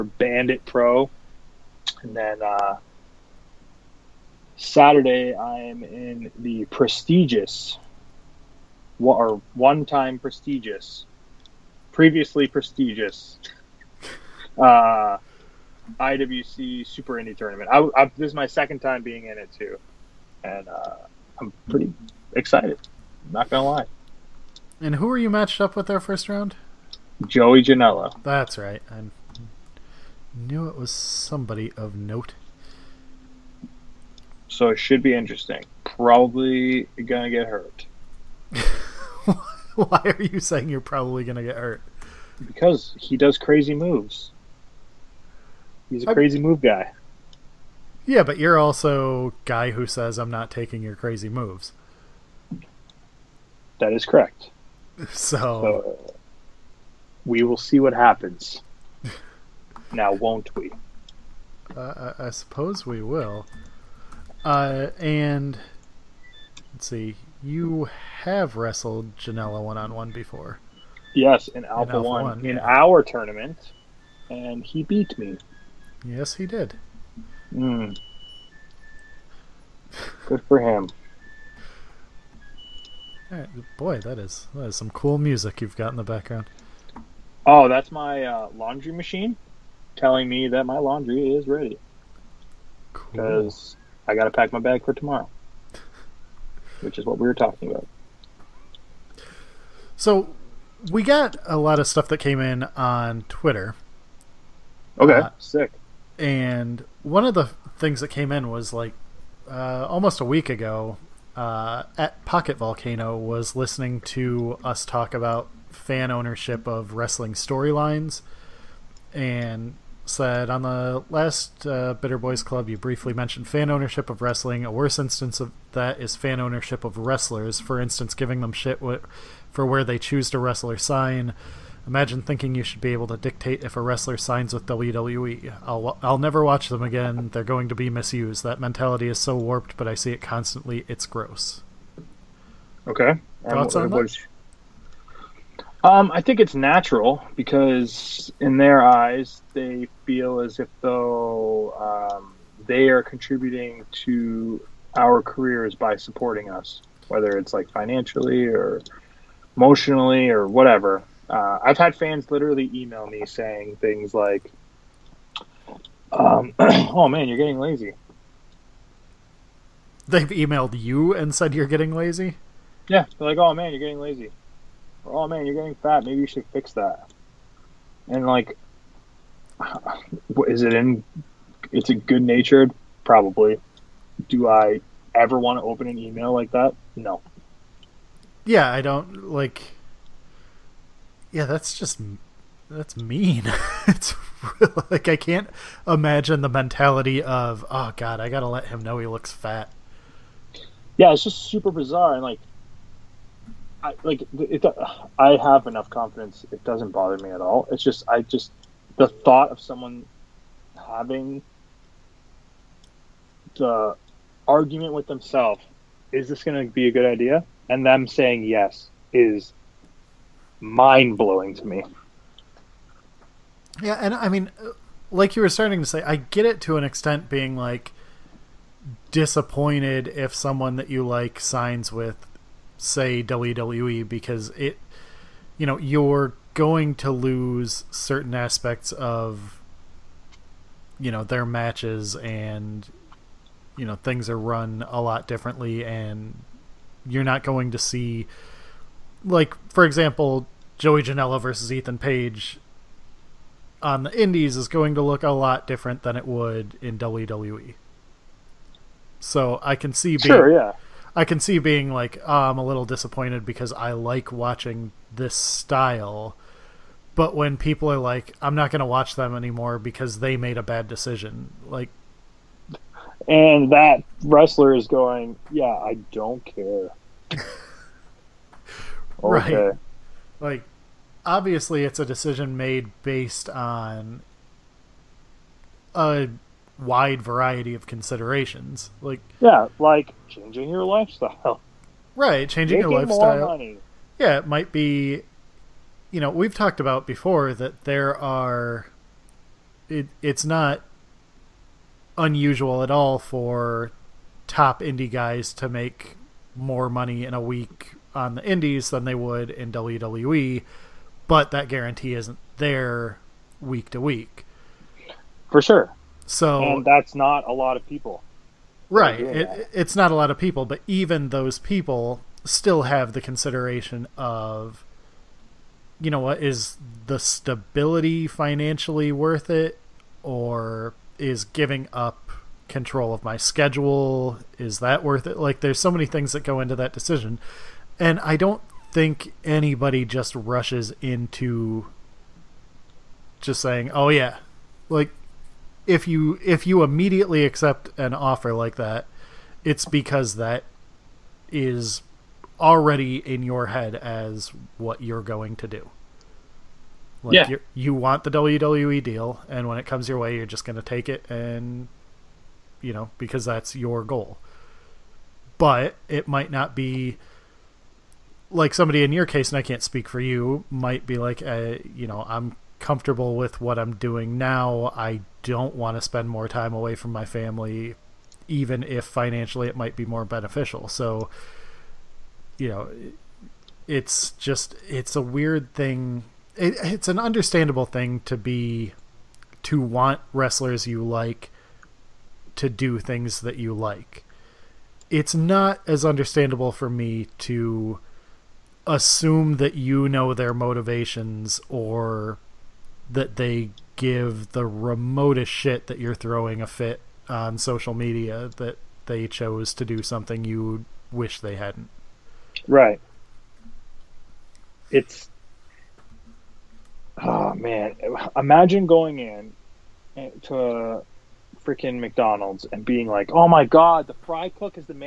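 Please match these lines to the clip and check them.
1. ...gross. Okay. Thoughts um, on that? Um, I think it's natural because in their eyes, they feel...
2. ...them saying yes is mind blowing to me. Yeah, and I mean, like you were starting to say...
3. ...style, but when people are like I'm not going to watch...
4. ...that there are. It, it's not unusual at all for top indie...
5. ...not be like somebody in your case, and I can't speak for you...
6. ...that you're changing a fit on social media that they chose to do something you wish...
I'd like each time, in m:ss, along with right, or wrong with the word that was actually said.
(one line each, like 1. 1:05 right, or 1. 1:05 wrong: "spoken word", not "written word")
1. 2:21 right
2. 3:37 right
3. 4:25 right
4. 4:57 right
5. 6:06 right
6. 6:45 wrong: "throwing", not "changing".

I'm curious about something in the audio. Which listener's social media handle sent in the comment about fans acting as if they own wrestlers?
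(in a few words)
Pocket Volcano.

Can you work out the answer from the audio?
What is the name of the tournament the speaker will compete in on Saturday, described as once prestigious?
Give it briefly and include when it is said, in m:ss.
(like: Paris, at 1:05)
IWC Super Indie Tournament, at 0:15.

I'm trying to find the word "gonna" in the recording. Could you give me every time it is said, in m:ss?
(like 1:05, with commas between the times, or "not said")
0:37, 0:41.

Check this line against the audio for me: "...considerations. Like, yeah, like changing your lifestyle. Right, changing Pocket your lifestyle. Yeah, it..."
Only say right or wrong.
wrong.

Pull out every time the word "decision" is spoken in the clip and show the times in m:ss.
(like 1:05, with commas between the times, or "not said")
4:30, 4:42, 5:36.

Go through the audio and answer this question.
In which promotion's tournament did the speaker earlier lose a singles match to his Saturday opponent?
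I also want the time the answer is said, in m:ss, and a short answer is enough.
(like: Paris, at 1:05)
Alpha One, at 1:11.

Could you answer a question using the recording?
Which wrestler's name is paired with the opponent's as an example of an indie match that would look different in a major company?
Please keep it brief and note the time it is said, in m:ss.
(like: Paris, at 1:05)
Ethan Page, at 4:11.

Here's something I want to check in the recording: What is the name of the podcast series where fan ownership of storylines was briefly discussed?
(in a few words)
Bitter Boys Club.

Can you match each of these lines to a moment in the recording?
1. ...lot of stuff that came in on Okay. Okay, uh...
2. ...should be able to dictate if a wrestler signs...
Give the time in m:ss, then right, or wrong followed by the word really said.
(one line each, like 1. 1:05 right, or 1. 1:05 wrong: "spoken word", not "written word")
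1. 1:41 wrong: "Twitter", not "Okay"
2. 2:12 right.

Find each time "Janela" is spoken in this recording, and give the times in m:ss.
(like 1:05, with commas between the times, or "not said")
0:27, 1:09, 4:11.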